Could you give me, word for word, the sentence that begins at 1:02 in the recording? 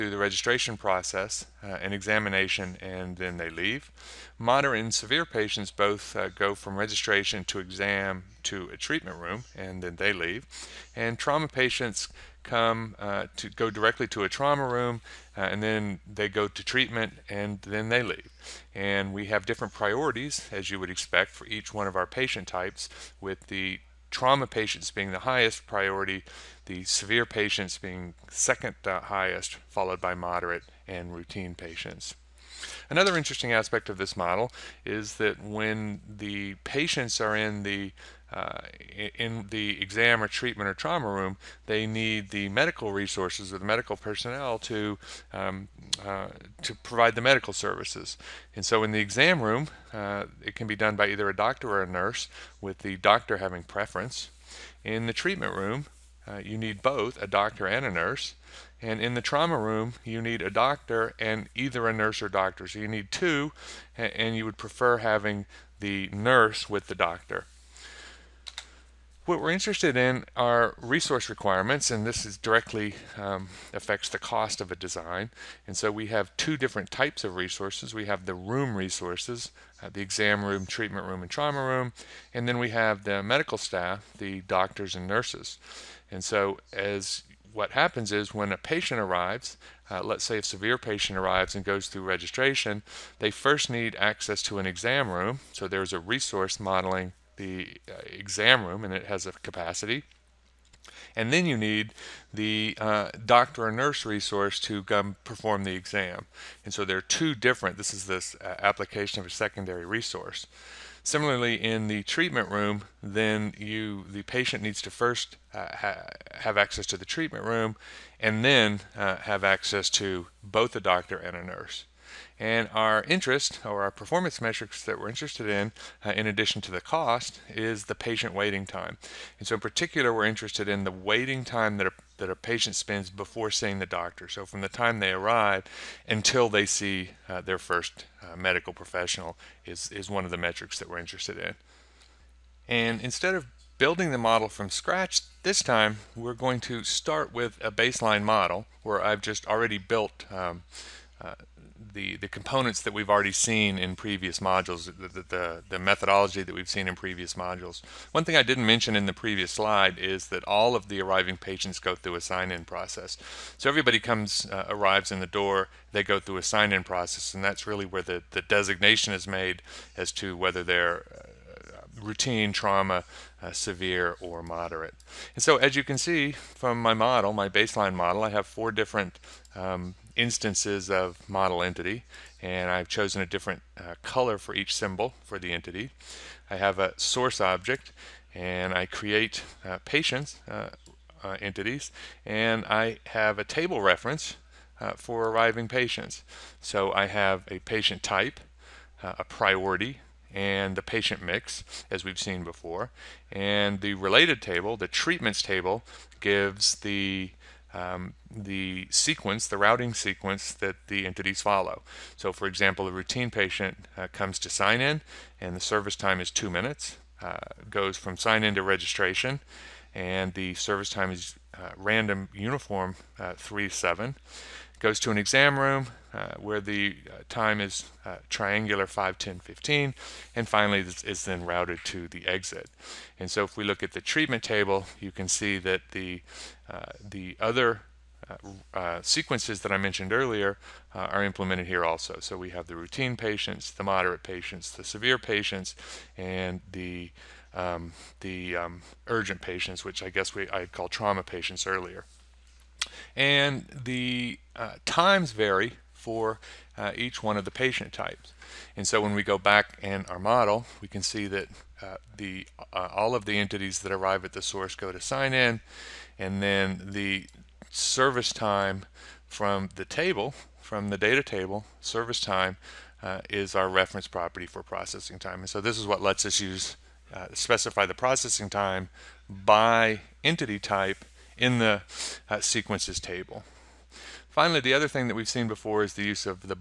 So you need two, and you would prefer having the nurse with the doctor.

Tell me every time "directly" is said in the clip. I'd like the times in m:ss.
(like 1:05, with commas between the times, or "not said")
0:13, 1:12.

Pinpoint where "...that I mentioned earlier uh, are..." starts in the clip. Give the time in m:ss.
3:59.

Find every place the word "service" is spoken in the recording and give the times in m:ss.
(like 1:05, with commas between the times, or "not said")
0:47, 3:35, 3:40, 4:27, 4:31.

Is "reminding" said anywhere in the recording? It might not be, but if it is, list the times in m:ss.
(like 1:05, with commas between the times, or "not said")
not said.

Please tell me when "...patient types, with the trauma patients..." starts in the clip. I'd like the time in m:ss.
0:22.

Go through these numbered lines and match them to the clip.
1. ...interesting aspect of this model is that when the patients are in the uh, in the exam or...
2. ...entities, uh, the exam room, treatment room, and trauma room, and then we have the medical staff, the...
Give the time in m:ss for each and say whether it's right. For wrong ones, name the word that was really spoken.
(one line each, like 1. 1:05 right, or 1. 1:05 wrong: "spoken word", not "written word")
1. 0:33 right
2. 1:18 wrong: "resources", not "entities".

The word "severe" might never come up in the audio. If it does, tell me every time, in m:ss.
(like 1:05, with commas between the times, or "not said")
0:04, 0:26, 1:30, 2:53, 4:04.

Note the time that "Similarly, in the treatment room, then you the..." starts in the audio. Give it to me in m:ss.
1:51.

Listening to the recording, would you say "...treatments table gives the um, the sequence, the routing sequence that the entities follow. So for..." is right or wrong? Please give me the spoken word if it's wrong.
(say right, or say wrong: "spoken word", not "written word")
right.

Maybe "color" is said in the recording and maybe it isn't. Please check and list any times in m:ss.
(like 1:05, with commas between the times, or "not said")
3:04.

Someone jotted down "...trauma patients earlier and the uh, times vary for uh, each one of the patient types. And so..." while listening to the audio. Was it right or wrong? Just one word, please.
right.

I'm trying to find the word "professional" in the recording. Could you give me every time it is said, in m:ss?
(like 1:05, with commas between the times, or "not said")
2:18.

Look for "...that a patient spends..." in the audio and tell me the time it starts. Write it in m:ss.
2:12.